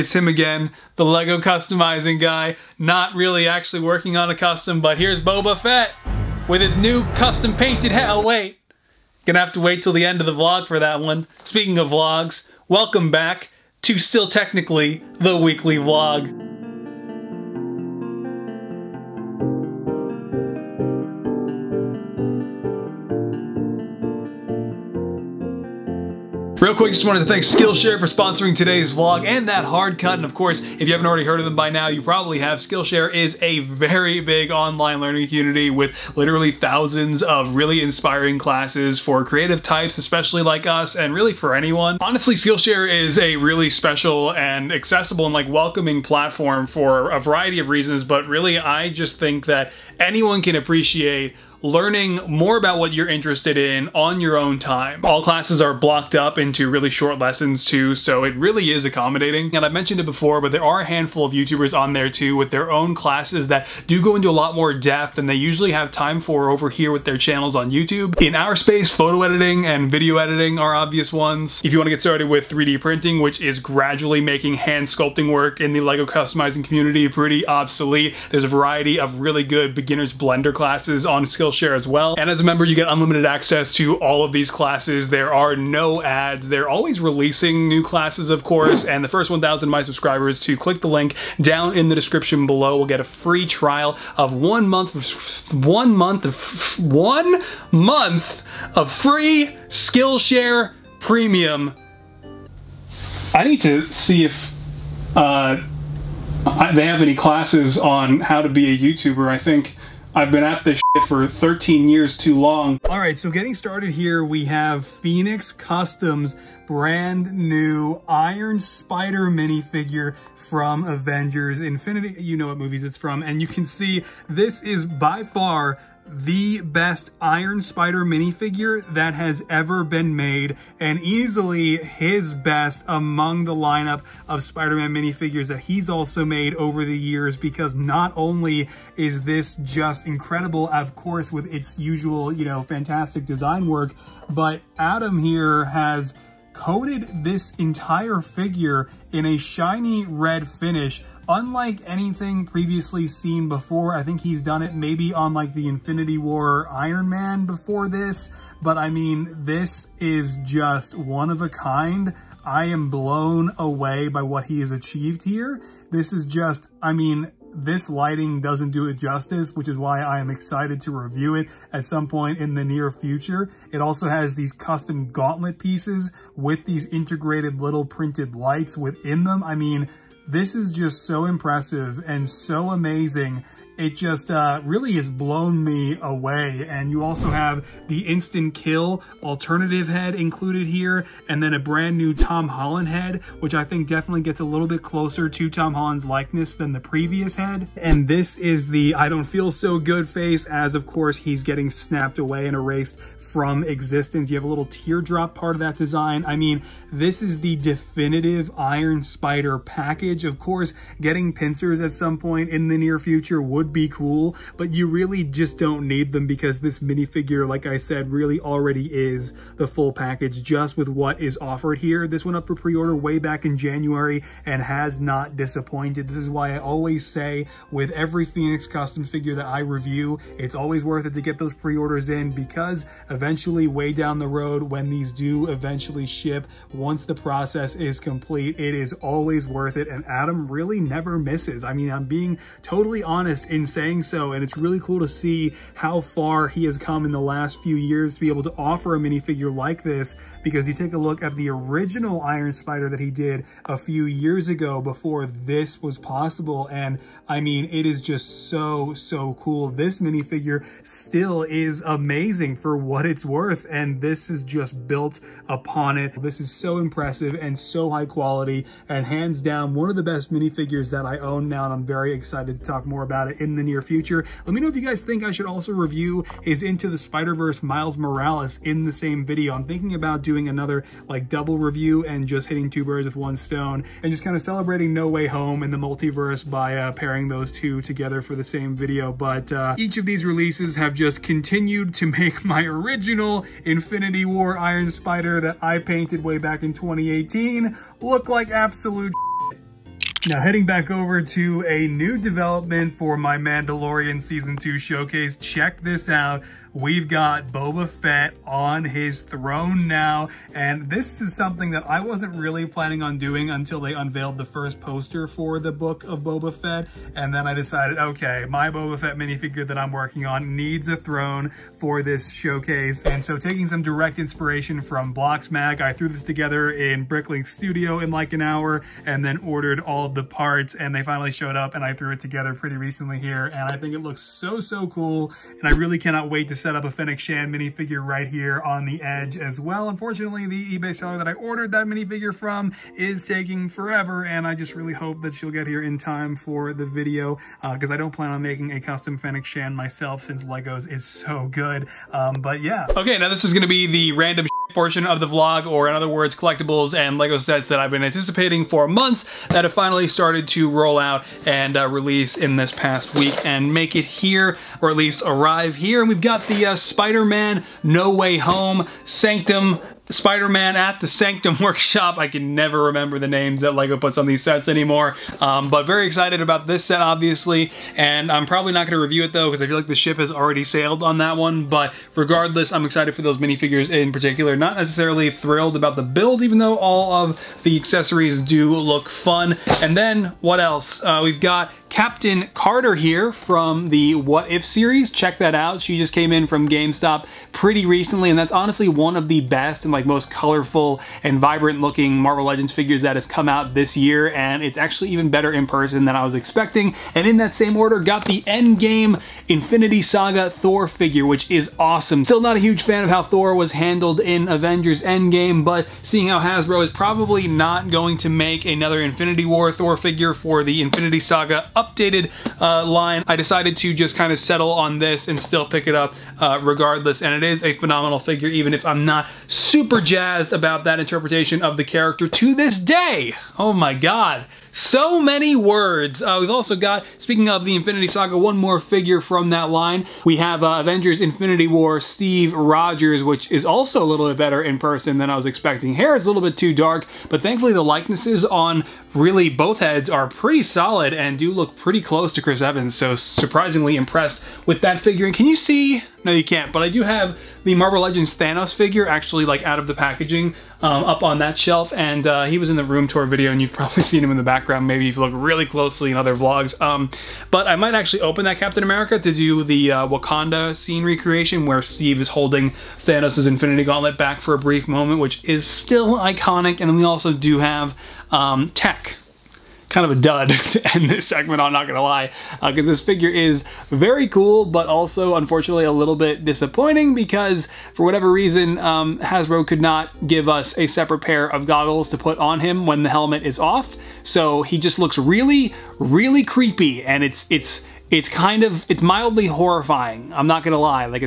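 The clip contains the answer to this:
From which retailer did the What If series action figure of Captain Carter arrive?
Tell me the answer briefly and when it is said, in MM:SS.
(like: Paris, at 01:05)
GameStop, at 06:36.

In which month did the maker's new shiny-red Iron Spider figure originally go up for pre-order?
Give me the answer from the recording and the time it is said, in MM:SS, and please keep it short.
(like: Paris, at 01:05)
January, at 03:43.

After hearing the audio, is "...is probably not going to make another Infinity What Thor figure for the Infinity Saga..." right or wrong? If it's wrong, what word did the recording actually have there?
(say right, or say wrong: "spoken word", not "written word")
wrong: "War", not "What".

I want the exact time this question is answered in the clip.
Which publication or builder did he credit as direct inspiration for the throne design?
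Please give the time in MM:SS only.
05:25.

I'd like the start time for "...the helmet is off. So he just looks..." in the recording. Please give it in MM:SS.
08:13.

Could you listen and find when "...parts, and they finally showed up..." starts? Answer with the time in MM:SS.
05:30.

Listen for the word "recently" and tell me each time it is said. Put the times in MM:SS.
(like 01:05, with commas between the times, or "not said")
05:32, 06:37.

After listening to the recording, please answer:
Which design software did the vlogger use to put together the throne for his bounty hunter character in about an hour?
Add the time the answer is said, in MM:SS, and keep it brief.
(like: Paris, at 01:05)
Bricklink Studio, at 05:27.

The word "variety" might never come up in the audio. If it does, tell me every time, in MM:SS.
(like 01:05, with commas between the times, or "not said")
00:47, 01:18.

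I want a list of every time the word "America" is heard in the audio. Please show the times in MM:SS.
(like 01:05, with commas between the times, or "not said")
07:48.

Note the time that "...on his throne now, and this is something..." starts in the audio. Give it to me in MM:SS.
05:08.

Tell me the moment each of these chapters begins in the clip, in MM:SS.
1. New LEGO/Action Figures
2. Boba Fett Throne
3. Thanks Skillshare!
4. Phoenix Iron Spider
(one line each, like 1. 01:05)
1. 05:52
2. 04:59
3. 00:26
4. 01:52.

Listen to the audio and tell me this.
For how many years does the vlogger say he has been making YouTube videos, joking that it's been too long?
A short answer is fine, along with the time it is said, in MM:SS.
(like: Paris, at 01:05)
13, at 01:51.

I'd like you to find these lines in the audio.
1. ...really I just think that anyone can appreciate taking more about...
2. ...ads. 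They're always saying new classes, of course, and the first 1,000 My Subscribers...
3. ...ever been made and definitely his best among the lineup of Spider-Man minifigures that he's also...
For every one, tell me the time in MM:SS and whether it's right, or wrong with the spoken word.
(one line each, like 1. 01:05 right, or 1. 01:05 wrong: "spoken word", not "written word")
1. 00:48 wrong: "learning", not "taking"
2. 01:26 wrong: "releasing", not "saying"
3. 02:09 wrong: "easily", not "definitely".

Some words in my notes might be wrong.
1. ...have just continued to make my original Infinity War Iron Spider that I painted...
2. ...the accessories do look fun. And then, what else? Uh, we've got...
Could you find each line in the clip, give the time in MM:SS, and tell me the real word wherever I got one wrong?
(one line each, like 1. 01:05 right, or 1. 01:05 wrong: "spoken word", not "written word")
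1. 04:50 right
2. 06:27 right.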